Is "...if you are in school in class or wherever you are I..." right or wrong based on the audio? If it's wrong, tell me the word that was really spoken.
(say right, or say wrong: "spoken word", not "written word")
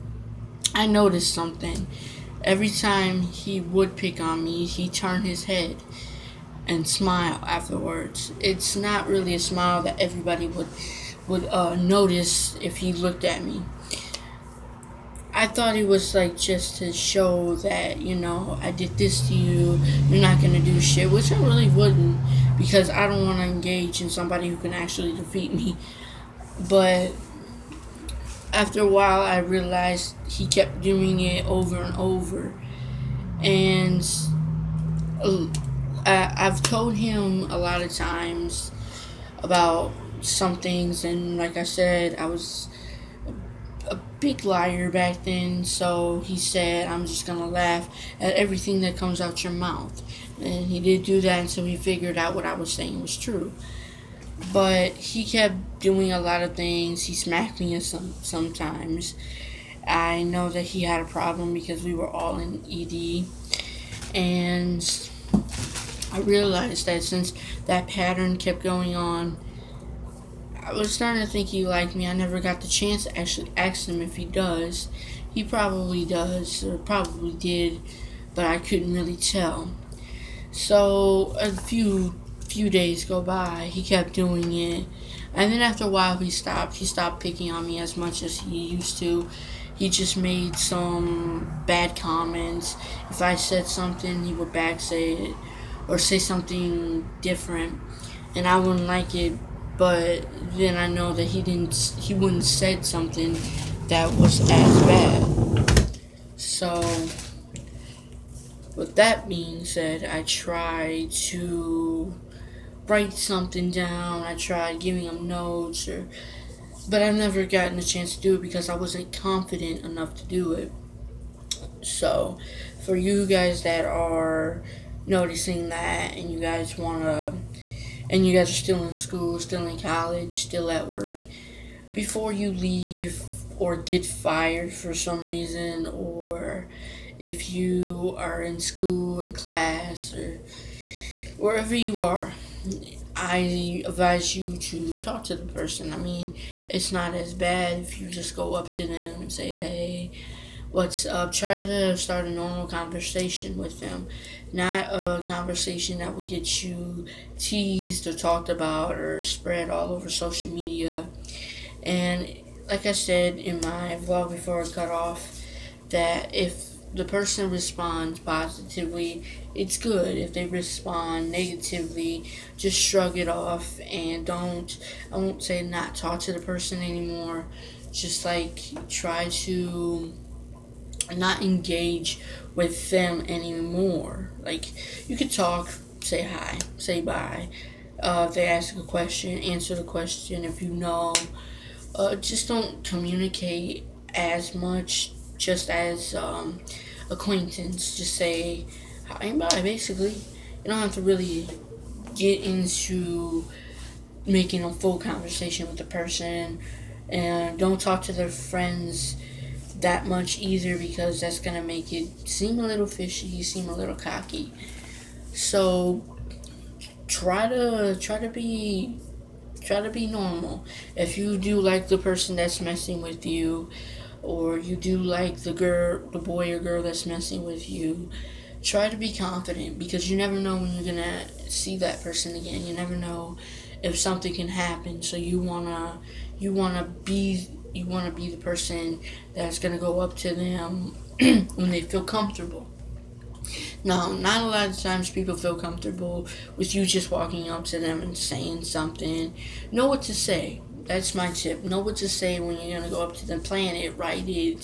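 right.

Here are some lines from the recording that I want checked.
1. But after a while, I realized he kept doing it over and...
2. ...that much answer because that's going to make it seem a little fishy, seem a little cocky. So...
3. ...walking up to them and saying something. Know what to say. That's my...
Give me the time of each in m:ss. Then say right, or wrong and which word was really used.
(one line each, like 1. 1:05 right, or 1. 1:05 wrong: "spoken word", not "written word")
1. 0:26 right
2. 3:29 wrong: "easier", not "answer"
3. 4:07 right.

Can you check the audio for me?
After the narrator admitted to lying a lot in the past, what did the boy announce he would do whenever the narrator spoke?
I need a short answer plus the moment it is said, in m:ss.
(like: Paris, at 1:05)
Laugh at everything, at 0:47.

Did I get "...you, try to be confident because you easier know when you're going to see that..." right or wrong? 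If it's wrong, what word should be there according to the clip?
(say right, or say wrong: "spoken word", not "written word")
wrong: "never", not "easier".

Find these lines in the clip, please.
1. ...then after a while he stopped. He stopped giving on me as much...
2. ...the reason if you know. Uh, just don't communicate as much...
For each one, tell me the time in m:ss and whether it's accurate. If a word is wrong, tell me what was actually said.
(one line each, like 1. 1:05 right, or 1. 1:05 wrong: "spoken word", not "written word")
1. 1:25 wrong: "picking", not "giving"
2. 3:09 wrong: "question", not "reason".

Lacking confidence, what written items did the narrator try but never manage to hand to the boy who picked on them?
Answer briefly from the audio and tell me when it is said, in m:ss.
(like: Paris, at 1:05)
Notes, at 1:55.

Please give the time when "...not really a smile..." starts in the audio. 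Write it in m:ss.
0:08.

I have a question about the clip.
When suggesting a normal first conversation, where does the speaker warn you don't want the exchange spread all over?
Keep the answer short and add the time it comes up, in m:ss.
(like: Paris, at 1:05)
Social media, at 2:40.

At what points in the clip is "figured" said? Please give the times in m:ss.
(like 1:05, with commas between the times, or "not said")
0:51.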